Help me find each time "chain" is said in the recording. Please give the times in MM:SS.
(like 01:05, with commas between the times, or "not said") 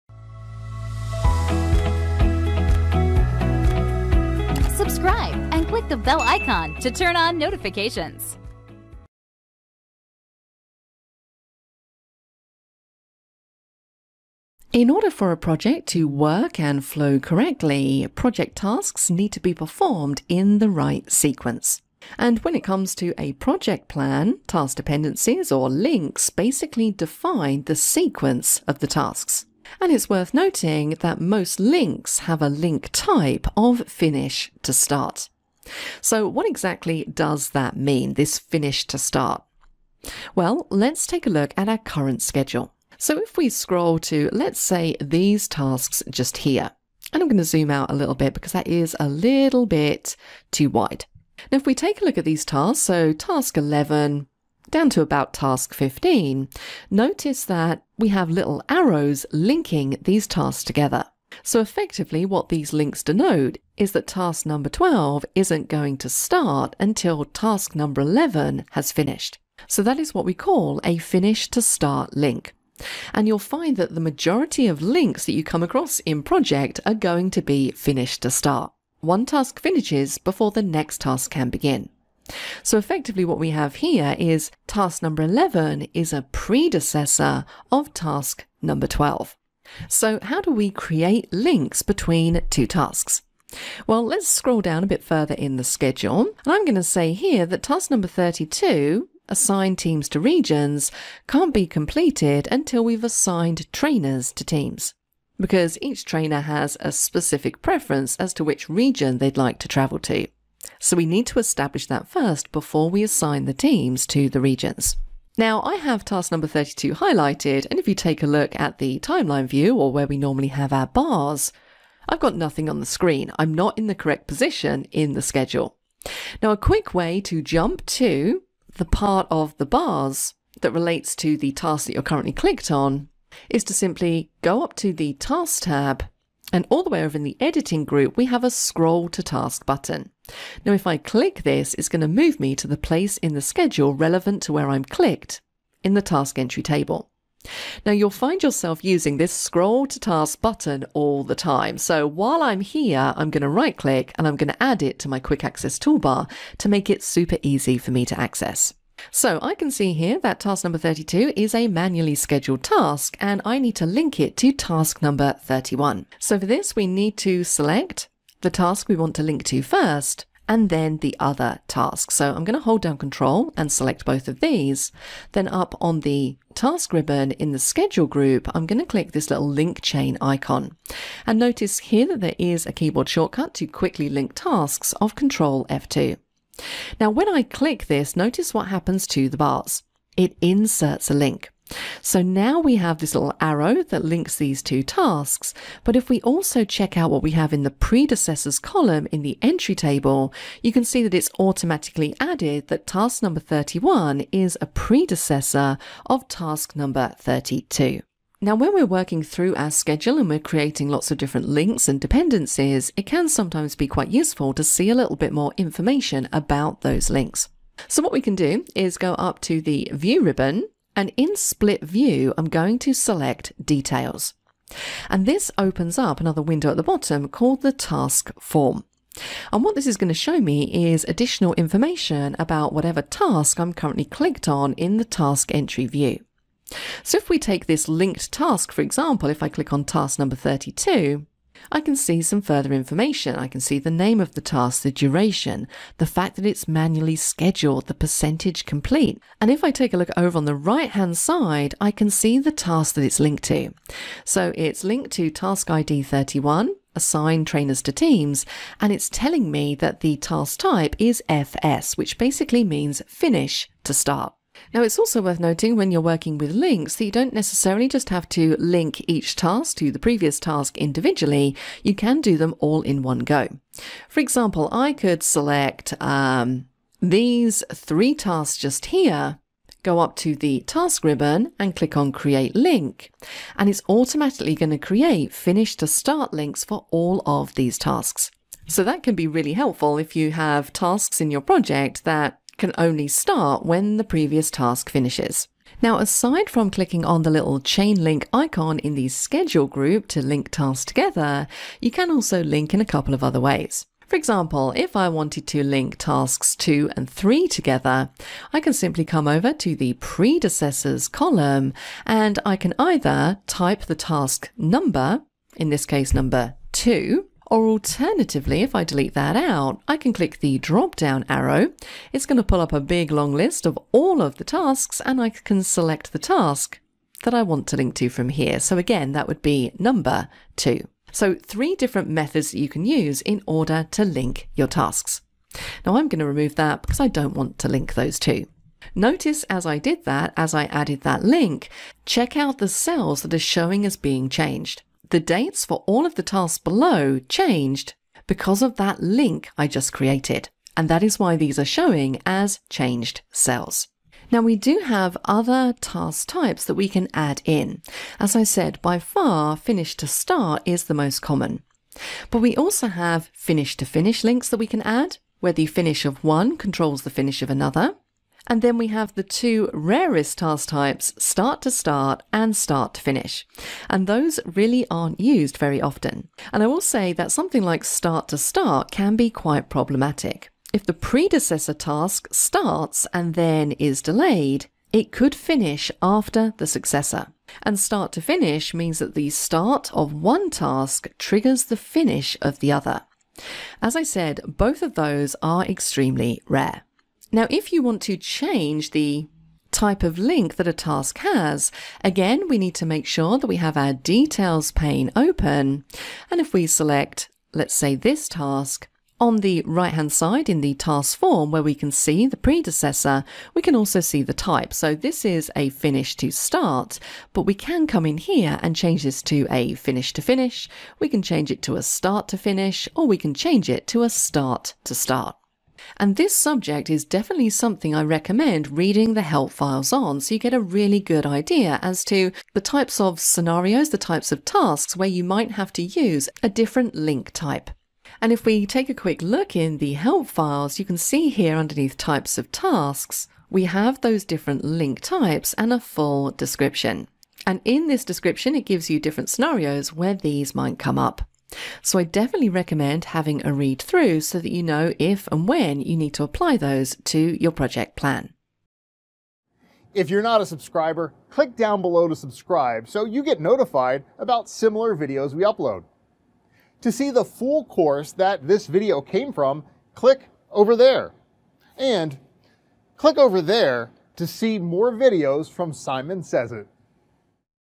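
02:59, 04:57.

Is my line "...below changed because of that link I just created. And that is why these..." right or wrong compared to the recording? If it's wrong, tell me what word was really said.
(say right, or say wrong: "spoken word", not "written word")
right.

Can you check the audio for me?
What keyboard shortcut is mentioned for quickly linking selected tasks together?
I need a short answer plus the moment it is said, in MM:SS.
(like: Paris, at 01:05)
Control F2, at 03:05.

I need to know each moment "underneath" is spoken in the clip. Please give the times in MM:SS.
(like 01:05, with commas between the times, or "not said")
07:21.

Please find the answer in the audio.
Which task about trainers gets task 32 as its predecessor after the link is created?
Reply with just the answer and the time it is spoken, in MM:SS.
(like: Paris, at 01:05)
Assign trainers to teams, at 04:16.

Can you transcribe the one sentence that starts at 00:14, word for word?
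In order for a project to work and flow correctly, project tasks need to be performed in the right sequence.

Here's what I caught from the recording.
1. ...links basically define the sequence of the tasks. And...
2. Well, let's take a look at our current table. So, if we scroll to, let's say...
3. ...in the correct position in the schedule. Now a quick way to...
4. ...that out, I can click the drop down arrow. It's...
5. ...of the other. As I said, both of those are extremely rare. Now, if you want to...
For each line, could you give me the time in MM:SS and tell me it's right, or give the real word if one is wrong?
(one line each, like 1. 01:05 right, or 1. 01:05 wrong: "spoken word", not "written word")
1. 00:25 right
2. 00:40 wrong: "schedule", not "table"
3. 02:03 right
4. 05:19 right
5. 06:32 right.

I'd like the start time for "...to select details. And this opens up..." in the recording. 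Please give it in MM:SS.
03:42.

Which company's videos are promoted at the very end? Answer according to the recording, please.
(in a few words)
Simon Sez IT.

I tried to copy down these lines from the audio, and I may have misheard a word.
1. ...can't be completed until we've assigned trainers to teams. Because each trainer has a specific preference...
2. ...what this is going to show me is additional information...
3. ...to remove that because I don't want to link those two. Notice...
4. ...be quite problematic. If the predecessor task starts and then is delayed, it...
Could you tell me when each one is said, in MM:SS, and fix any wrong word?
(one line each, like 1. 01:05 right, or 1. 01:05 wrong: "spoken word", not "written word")
1. 01:41 right
2. 03:49 right
3. 05:36 right
4. 06:19 right.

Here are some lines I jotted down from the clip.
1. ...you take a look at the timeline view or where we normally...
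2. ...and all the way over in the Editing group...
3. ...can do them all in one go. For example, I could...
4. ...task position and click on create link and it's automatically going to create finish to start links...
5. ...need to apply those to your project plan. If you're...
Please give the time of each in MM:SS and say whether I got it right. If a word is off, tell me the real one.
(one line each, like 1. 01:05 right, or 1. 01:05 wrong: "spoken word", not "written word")
1. 01:57 right
2. 02:16 right
3. 04:31 right
4. 04:40 wrong: "ribbon", not "position"
5. 07:35 right.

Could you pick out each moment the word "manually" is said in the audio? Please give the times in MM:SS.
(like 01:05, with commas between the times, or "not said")
02:41, 04:06.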